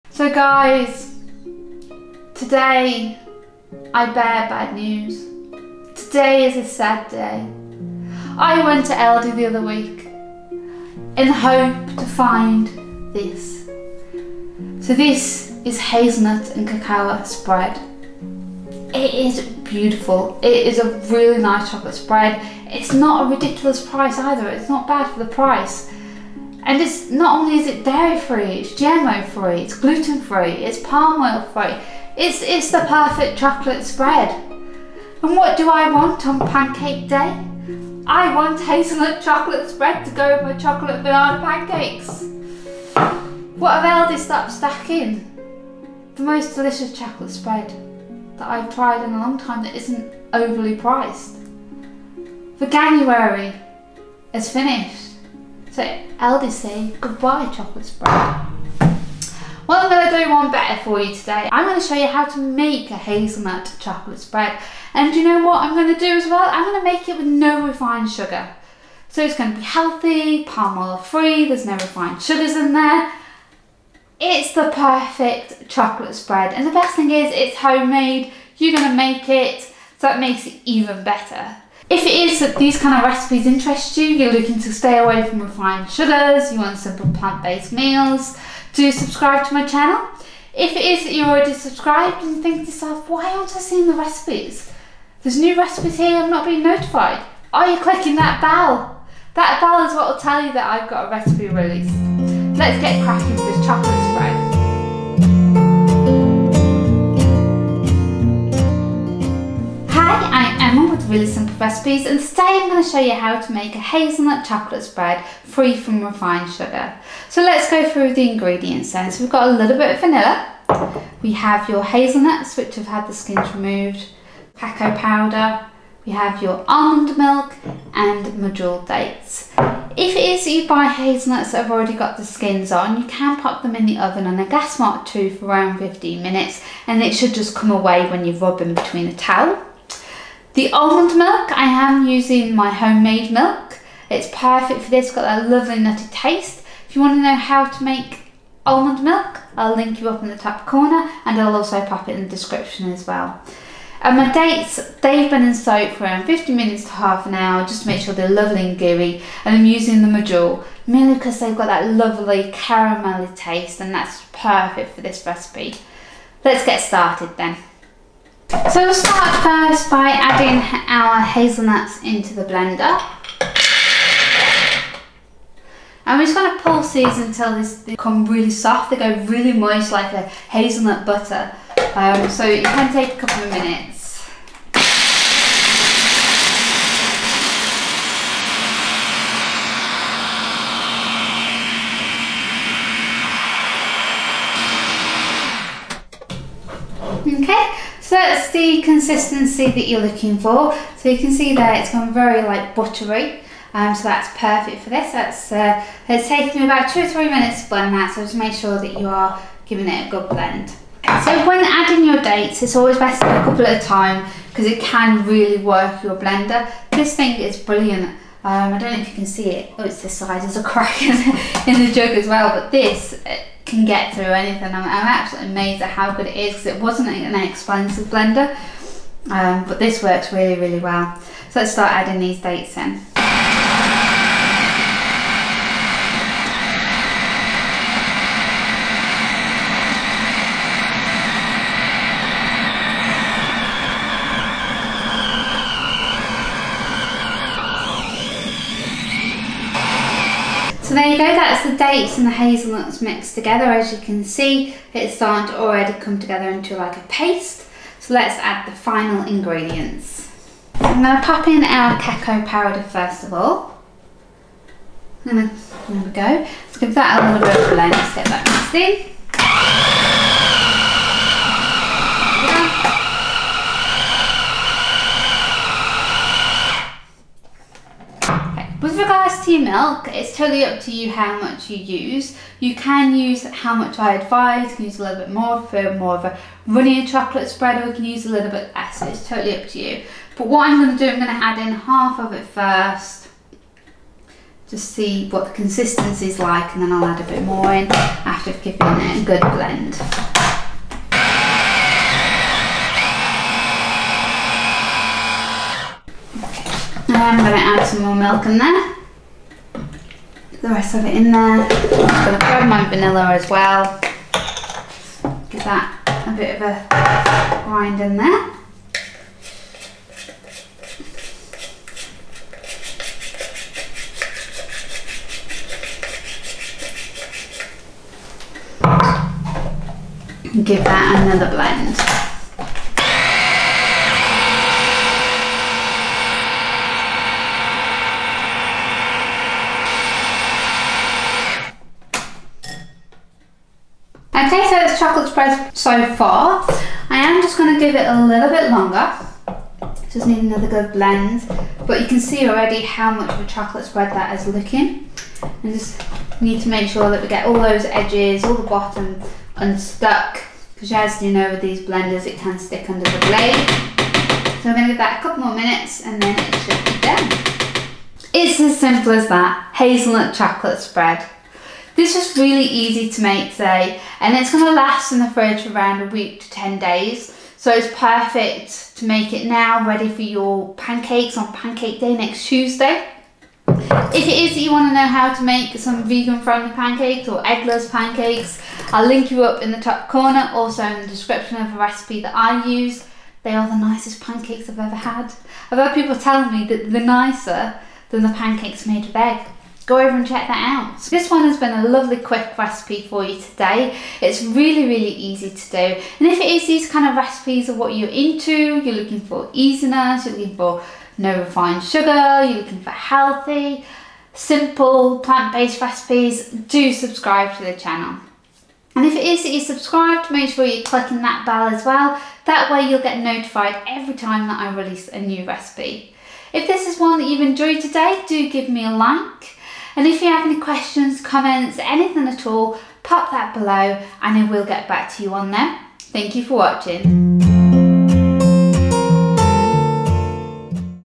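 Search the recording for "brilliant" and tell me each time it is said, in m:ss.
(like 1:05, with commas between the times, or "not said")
3:37.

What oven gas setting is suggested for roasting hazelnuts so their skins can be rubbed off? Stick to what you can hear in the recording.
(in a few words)
gas mark 2.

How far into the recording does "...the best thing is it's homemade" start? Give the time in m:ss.
1:16.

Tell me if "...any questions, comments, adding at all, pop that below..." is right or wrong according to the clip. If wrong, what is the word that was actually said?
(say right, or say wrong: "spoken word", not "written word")
wrong: "anything", not "adding".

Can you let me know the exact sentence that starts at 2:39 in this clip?
And I'm using the medjool mainly because they've got that lovely caramelly taste and that's perfect for this recipe.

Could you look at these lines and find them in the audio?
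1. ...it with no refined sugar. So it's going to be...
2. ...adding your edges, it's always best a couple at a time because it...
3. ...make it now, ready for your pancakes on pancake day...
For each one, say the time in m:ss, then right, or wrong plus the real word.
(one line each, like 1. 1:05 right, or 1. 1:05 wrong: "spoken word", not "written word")
1. 1:07 right
2. 3:31 wrong: "dates", not "edges"
3. 6:19 right.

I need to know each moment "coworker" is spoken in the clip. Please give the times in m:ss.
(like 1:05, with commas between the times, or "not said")
not said.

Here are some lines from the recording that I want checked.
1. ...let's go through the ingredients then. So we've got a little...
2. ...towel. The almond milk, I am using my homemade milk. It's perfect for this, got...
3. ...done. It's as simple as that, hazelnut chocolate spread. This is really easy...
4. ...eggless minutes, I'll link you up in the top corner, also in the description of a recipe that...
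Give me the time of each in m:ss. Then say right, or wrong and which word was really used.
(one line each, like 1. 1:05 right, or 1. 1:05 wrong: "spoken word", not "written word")
1. 1:57 right
2. 2:19 right
3. 6:06 right
4. 6:27 wrong: "pancakes", not "minutes".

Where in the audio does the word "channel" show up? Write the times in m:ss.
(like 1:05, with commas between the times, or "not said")
1:29, 6:57.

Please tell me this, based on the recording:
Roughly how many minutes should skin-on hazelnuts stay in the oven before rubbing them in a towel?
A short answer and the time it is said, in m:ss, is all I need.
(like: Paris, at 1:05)
15 minutes, at 2:15.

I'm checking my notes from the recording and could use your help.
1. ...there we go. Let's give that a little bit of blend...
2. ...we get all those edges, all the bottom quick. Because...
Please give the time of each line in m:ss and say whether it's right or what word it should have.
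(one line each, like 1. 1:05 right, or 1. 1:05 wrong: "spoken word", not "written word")
1. 4:25 right
2. 5:57 wrong: "unstuck", not "quick".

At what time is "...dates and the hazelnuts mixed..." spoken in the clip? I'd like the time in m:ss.
4:11.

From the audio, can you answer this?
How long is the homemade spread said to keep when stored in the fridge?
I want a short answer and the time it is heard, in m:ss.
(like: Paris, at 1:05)
a week to 10 days, at 6:16.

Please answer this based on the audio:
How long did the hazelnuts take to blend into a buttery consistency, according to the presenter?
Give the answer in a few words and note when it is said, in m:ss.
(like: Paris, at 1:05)
2 or 3 minutes, at 3:26.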